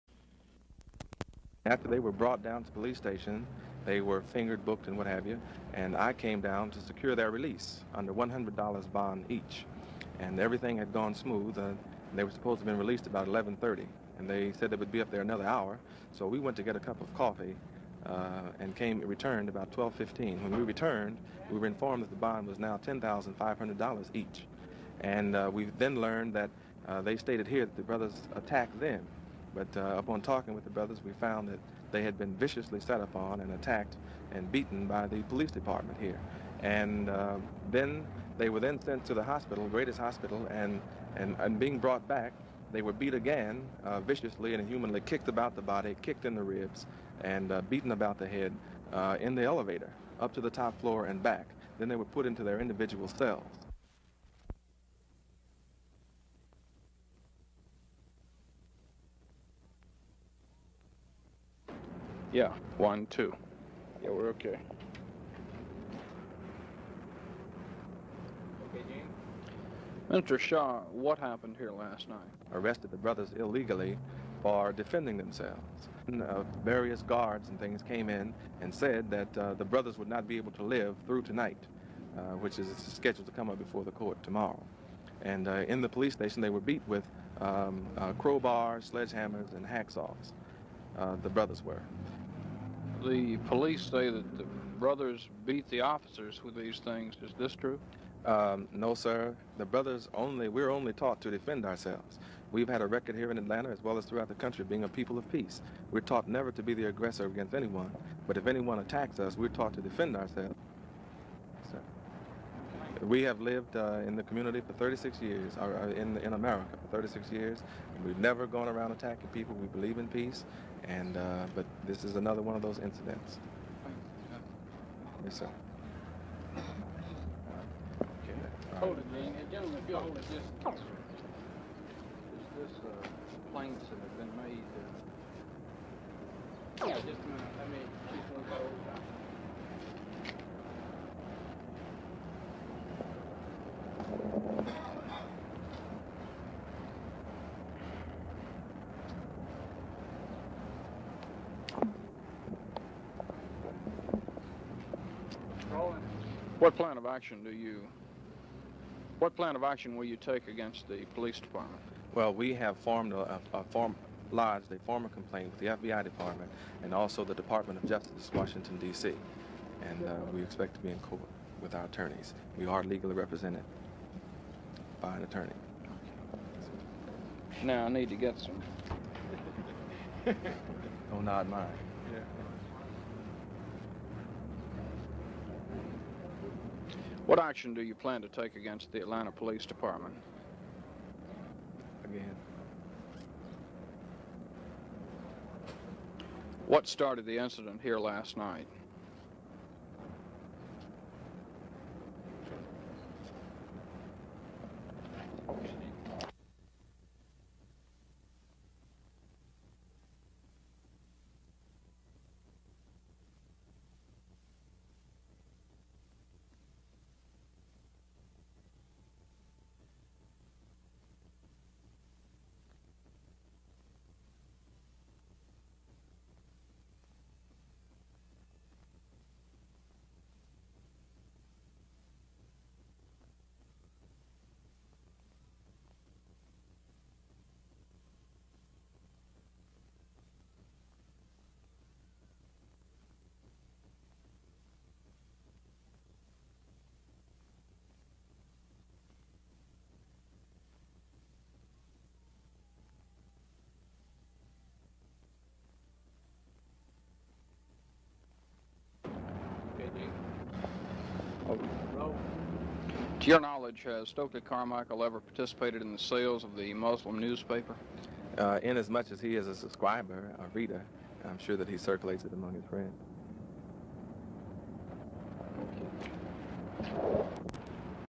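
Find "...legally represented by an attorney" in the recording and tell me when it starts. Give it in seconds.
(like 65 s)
172 s.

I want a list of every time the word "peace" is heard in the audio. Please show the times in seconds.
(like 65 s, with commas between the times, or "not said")
105 s, 120 s.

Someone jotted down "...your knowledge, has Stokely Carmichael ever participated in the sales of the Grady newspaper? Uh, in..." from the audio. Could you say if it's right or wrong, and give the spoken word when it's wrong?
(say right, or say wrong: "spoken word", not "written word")
wrong: "Muslim", not "Grady".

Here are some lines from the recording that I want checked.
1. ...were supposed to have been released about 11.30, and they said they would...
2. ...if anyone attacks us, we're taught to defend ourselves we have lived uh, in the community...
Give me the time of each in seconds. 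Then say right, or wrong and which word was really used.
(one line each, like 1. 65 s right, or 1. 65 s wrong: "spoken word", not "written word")
1. 12 s right
2. 108 s right.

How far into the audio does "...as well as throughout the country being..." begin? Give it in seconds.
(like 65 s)
103 s.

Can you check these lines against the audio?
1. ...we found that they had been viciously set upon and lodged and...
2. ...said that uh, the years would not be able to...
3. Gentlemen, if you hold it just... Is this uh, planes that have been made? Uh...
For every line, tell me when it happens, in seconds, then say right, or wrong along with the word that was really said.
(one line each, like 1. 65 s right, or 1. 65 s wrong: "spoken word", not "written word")
1. 31 s wrong: "attacked", not "lodged"
2. 78 s wrong: "brothers", not "years"
3. 129 s right.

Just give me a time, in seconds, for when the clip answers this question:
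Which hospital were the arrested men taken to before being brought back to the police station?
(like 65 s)
39 s.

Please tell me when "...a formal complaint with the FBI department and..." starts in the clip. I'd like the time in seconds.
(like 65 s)
164 s.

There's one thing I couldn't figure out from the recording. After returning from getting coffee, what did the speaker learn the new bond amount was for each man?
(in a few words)
$10,500.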